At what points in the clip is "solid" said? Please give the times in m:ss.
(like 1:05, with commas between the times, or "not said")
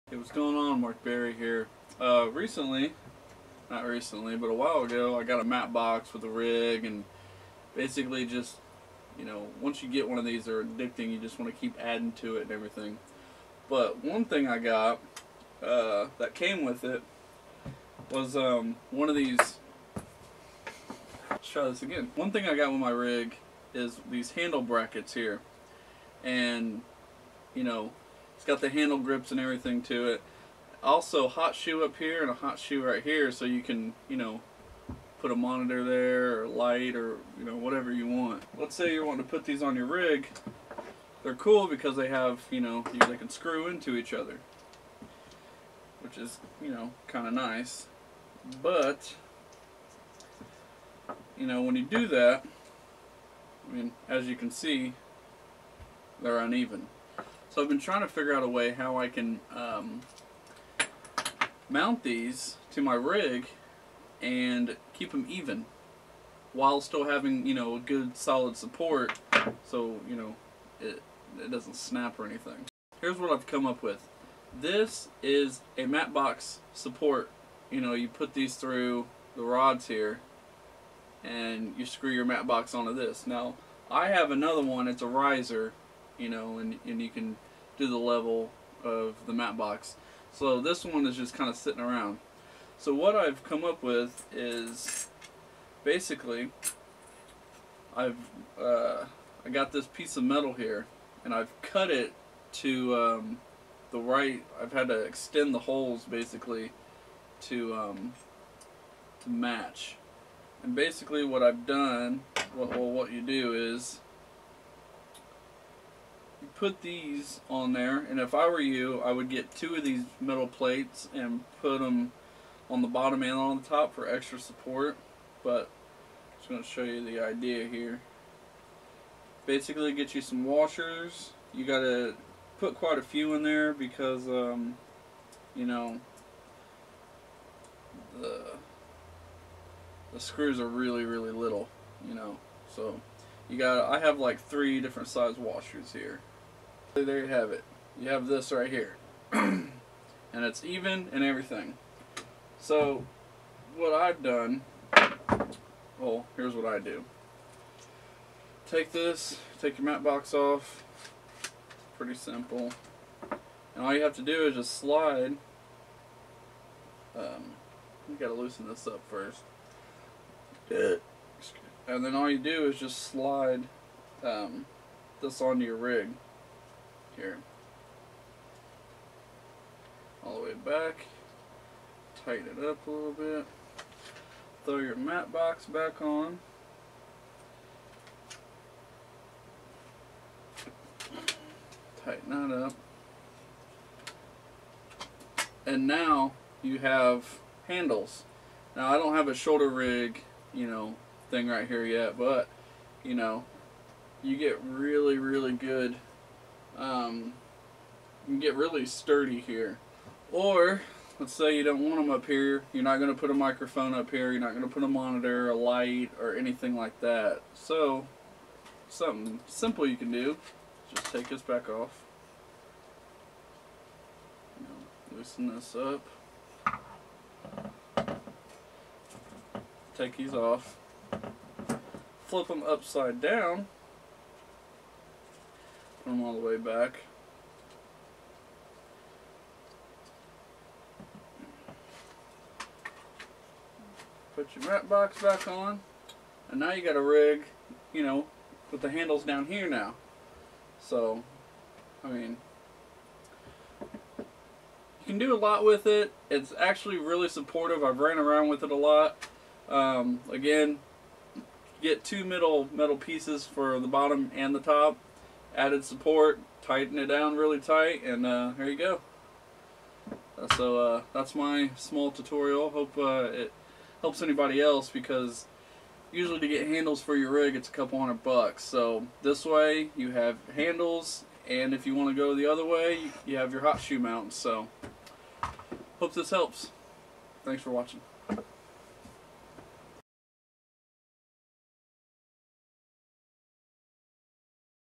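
1:08.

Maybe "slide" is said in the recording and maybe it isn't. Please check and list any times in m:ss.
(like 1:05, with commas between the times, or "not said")
2:44, 2:53.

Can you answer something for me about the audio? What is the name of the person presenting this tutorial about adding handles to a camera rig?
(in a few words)
Mark Berry.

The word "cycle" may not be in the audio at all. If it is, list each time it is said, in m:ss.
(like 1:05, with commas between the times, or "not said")
not said.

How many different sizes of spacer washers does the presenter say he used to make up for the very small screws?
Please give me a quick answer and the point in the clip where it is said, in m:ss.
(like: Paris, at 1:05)
3, at 2:24.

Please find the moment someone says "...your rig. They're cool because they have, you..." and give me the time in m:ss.
0:39.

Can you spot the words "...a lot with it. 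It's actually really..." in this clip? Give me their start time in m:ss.
4:15.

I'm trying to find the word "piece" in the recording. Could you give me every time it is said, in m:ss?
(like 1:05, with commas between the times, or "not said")
1:39, 4:22.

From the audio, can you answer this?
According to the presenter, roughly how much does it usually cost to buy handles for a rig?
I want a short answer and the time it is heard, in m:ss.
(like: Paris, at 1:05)
a couple hundred bucks, at 4:37.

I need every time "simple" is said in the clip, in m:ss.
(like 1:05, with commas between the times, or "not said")
2:42, 3:39.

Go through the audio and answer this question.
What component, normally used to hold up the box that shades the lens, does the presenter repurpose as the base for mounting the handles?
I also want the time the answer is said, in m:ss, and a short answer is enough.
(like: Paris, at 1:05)
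mat box support, at 1:15.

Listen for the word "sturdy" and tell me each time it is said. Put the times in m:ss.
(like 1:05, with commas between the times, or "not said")
3:28.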